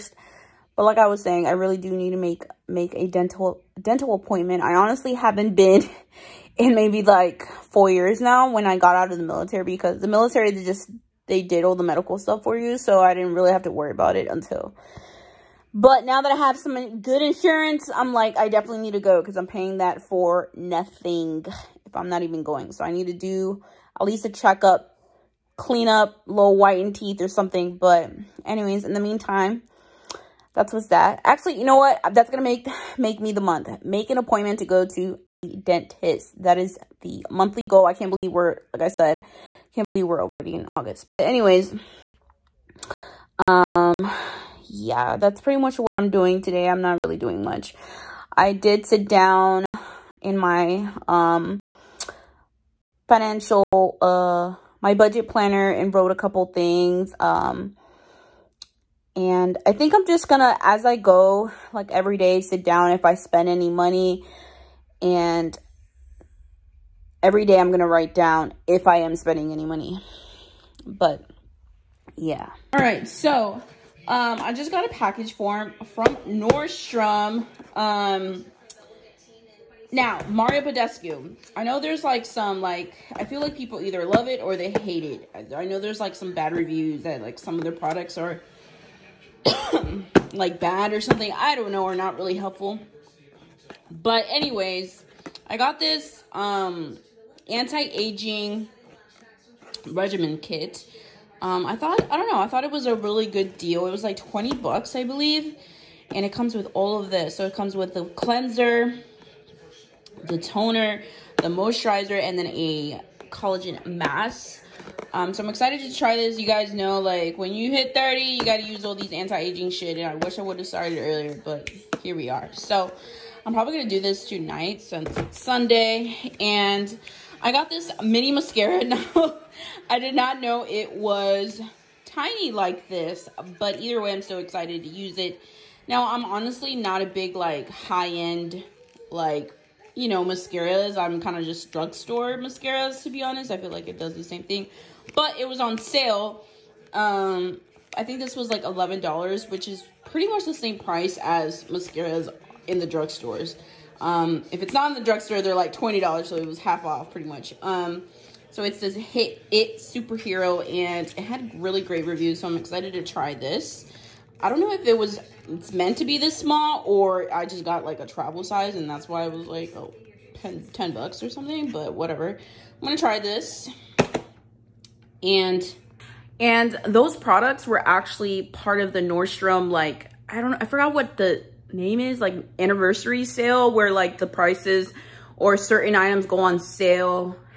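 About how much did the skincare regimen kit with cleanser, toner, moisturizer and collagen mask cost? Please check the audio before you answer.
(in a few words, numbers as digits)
$20.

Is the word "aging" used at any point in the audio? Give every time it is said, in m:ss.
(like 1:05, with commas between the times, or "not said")
1:37, 1:59.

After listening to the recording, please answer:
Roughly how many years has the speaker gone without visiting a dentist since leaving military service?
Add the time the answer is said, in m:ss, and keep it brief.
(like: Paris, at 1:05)
4, at 0:07.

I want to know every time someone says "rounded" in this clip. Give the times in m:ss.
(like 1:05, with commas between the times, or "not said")
not said.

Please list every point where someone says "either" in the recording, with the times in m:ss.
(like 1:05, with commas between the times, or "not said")
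1:23, 2:13.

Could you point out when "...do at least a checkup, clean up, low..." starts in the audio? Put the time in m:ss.
0:23.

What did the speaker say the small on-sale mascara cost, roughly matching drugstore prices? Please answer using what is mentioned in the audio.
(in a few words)
$11.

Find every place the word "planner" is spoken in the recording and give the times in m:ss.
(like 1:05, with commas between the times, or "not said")
0:55.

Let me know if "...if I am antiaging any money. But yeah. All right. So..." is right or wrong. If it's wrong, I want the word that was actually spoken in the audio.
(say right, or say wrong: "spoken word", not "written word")
wrong: "spending", not "antiaging".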